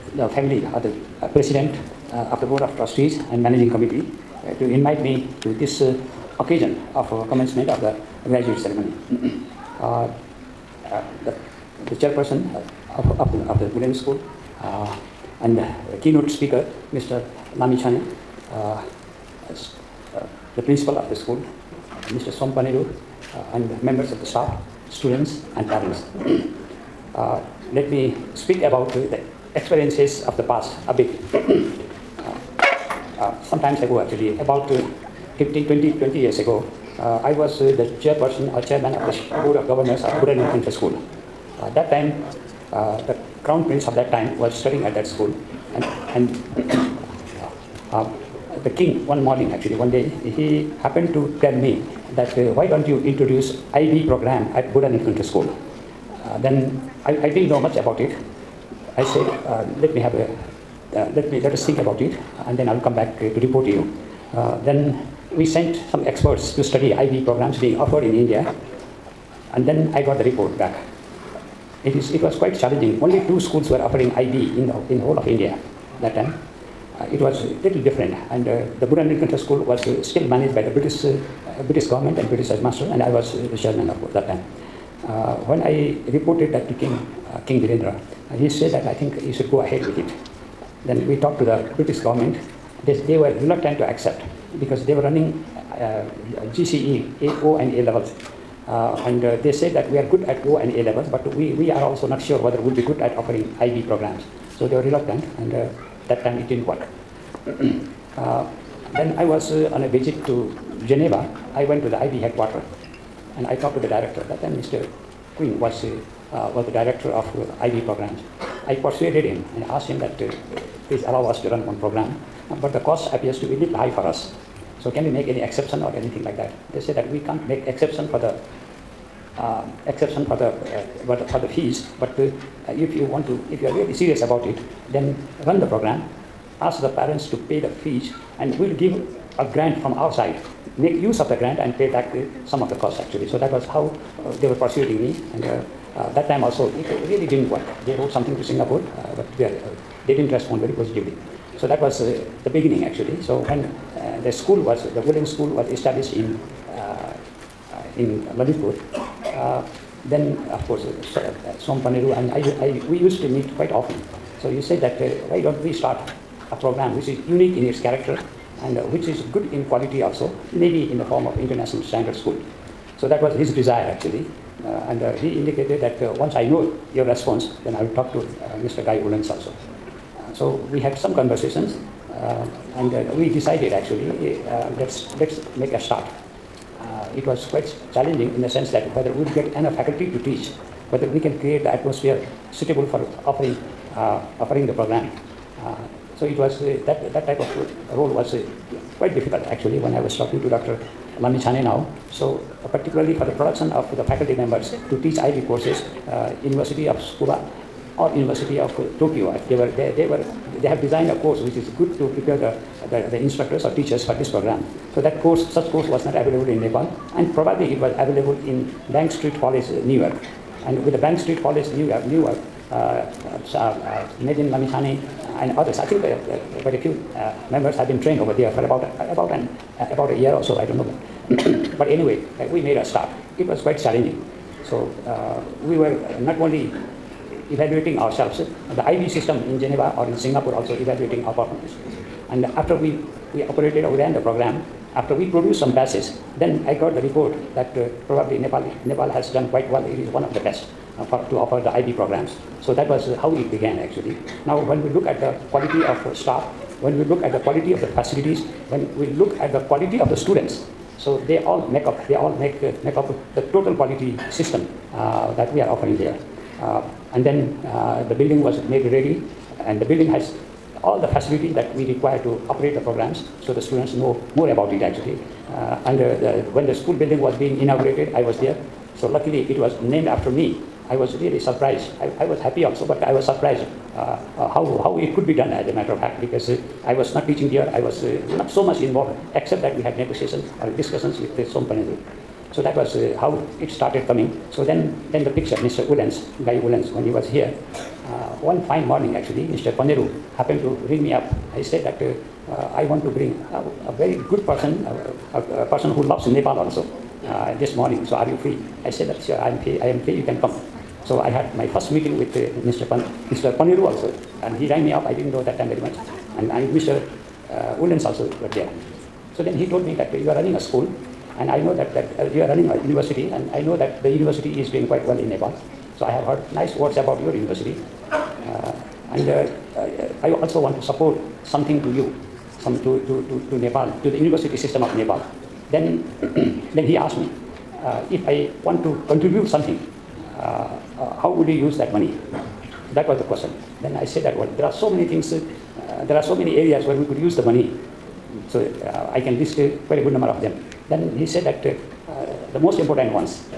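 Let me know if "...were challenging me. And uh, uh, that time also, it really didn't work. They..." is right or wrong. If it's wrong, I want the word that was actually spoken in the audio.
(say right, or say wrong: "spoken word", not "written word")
wrong: "persuading", not "challenging".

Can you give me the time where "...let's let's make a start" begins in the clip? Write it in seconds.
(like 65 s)
184 s.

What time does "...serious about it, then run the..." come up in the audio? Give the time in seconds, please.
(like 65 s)
133 s.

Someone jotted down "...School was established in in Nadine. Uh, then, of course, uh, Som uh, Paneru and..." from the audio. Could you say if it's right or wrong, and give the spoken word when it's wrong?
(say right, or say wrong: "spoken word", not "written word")
wrong: "Lalitpur", not "Nadine".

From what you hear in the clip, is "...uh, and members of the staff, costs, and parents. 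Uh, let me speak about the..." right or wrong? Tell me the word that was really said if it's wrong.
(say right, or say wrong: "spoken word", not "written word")
wrong: "students", not "costs".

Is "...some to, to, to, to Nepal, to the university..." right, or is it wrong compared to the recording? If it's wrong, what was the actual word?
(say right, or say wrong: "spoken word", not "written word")
right.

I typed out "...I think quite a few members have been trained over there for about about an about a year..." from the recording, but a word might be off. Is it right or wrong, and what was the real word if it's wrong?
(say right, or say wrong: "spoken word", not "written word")
right.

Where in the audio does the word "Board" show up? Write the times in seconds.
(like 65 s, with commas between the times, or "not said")
2 s, 39 s.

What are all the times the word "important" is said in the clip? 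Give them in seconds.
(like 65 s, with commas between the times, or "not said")
352 s.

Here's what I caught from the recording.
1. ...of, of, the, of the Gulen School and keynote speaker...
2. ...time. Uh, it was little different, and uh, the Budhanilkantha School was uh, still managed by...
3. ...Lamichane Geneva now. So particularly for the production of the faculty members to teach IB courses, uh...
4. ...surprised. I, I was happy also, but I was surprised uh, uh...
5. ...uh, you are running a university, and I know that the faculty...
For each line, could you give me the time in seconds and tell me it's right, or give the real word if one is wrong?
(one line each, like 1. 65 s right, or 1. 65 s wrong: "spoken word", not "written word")
1. 13 s right
2. 76 s right
3. 201 s wrong: "Chane", not "Geneva"
4. 281 s right
5. 322 s wrong: "university", not "faculty".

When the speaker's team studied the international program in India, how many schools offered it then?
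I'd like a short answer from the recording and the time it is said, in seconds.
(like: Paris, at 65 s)
2, at 73 s.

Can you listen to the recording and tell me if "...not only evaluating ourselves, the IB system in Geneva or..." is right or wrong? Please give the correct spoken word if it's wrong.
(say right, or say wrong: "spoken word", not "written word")
right.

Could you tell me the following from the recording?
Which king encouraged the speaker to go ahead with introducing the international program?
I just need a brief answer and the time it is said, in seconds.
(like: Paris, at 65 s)
King Birendra, at 87 s.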